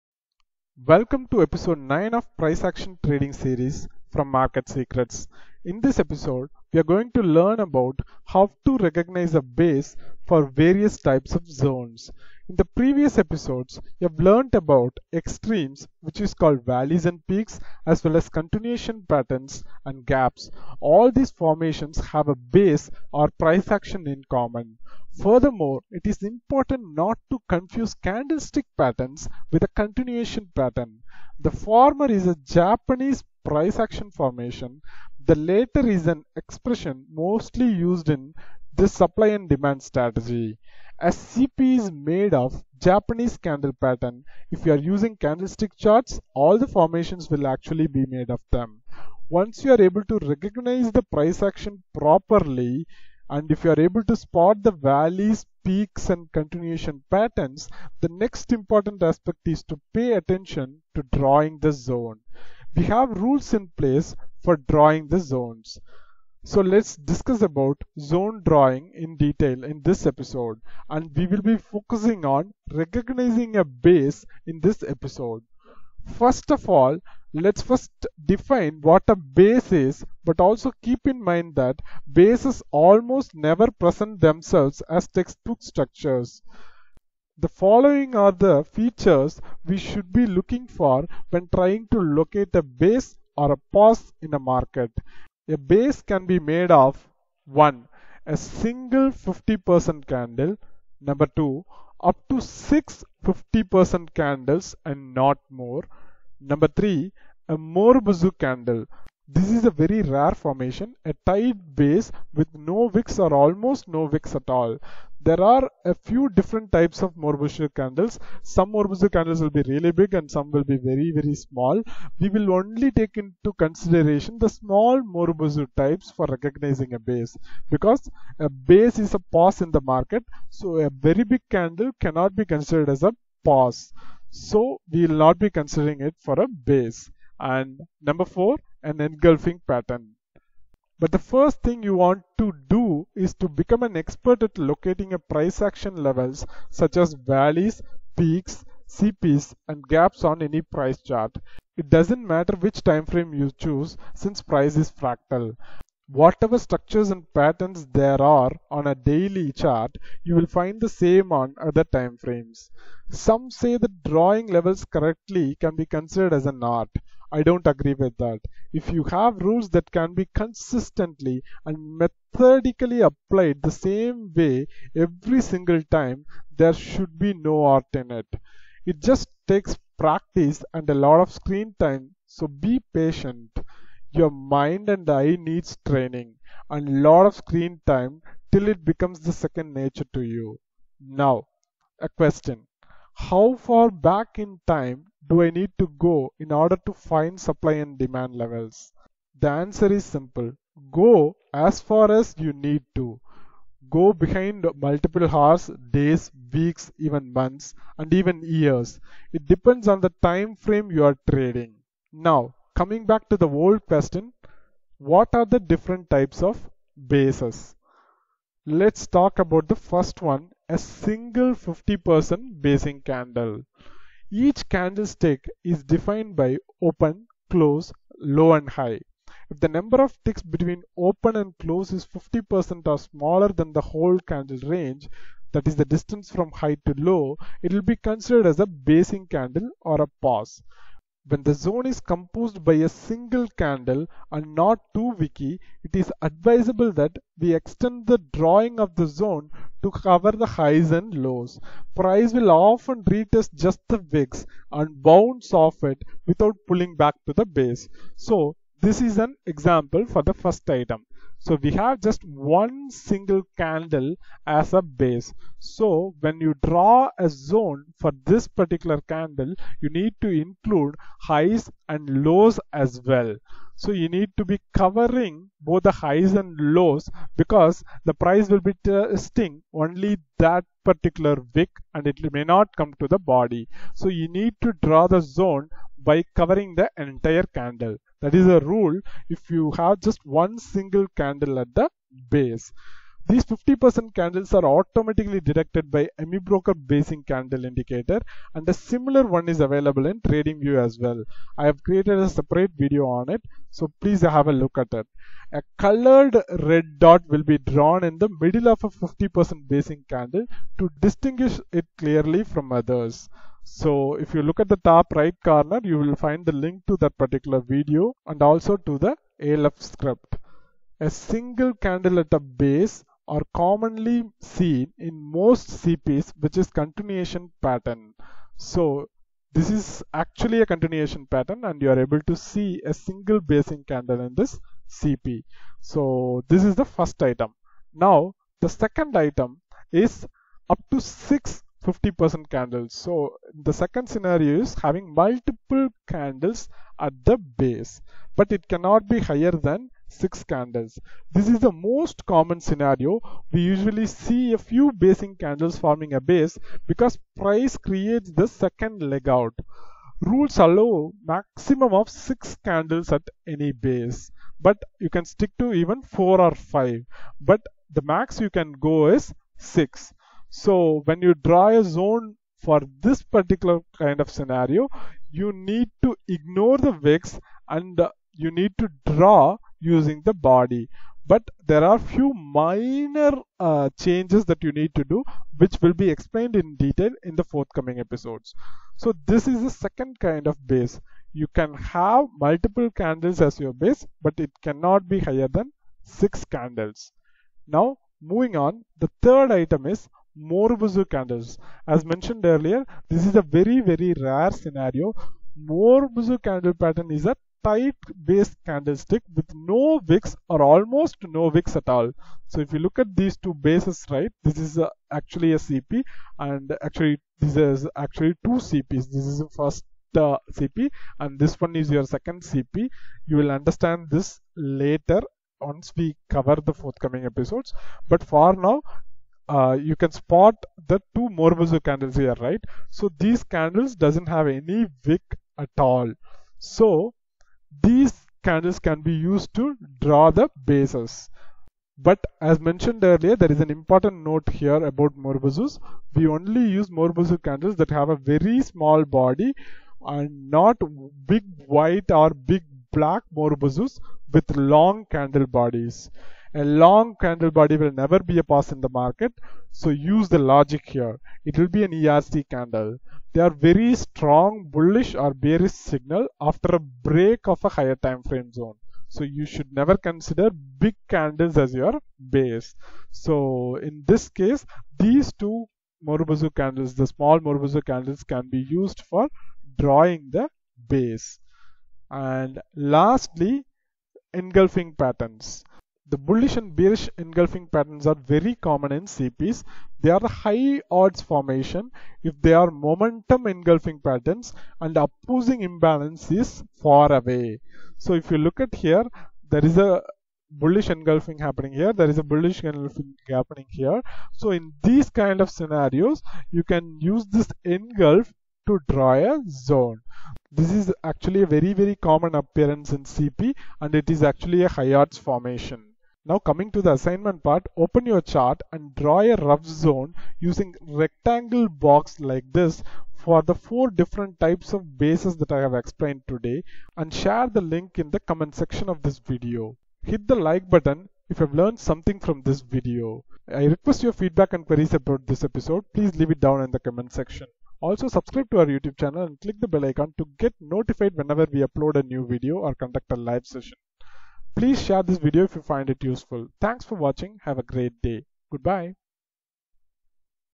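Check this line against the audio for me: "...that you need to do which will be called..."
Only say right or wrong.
wrong.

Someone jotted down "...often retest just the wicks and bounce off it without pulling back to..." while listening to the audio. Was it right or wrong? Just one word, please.
right.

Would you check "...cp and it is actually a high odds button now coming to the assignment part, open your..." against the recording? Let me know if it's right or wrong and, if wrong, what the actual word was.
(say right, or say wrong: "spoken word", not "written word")
wrong: "formation", not "button".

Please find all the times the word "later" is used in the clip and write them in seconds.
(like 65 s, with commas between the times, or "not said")
424 s.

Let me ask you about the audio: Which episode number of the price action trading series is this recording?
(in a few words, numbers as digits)
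9.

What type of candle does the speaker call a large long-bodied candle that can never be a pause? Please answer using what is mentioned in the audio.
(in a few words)
ERC candle.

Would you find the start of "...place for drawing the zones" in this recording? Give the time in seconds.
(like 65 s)
63 s.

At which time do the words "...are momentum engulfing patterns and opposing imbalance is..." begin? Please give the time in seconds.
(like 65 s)
492 s.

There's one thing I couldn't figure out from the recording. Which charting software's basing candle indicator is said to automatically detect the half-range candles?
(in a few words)
AmiBroker.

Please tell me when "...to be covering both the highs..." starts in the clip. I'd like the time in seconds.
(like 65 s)
274 s.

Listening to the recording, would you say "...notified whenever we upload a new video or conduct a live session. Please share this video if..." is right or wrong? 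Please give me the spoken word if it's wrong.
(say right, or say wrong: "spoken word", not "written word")
right.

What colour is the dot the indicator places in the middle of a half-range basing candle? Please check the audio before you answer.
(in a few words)
Red.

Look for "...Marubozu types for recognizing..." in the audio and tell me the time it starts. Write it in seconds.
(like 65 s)
125 s.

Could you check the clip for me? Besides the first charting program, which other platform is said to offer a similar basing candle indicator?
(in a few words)
TradingView.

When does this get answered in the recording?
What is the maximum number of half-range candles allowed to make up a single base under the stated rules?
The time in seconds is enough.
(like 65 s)
102 s.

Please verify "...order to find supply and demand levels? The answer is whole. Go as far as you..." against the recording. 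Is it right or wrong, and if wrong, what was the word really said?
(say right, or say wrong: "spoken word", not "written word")
wrong: "simple", not "whole".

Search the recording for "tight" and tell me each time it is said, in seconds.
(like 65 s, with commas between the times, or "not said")
111 s, 407 s.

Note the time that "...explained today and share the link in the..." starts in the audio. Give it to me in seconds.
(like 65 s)
525 s.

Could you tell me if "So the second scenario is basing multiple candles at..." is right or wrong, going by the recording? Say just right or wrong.
wrong.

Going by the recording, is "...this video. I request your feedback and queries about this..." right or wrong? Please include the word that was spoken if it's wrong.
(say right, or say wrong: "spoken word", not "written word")
right.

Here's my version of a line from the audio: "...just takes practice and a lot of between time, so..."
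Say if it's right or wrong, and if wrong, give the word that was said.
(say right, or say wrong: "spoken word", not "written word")
wrong: "screen", not "between".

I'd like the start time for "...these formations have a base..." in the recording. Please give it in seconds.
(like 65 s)
21 s.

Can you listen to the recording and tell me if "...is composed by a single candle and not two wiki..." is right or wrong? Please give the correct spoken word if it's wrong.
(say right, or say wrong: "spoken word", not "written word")
right.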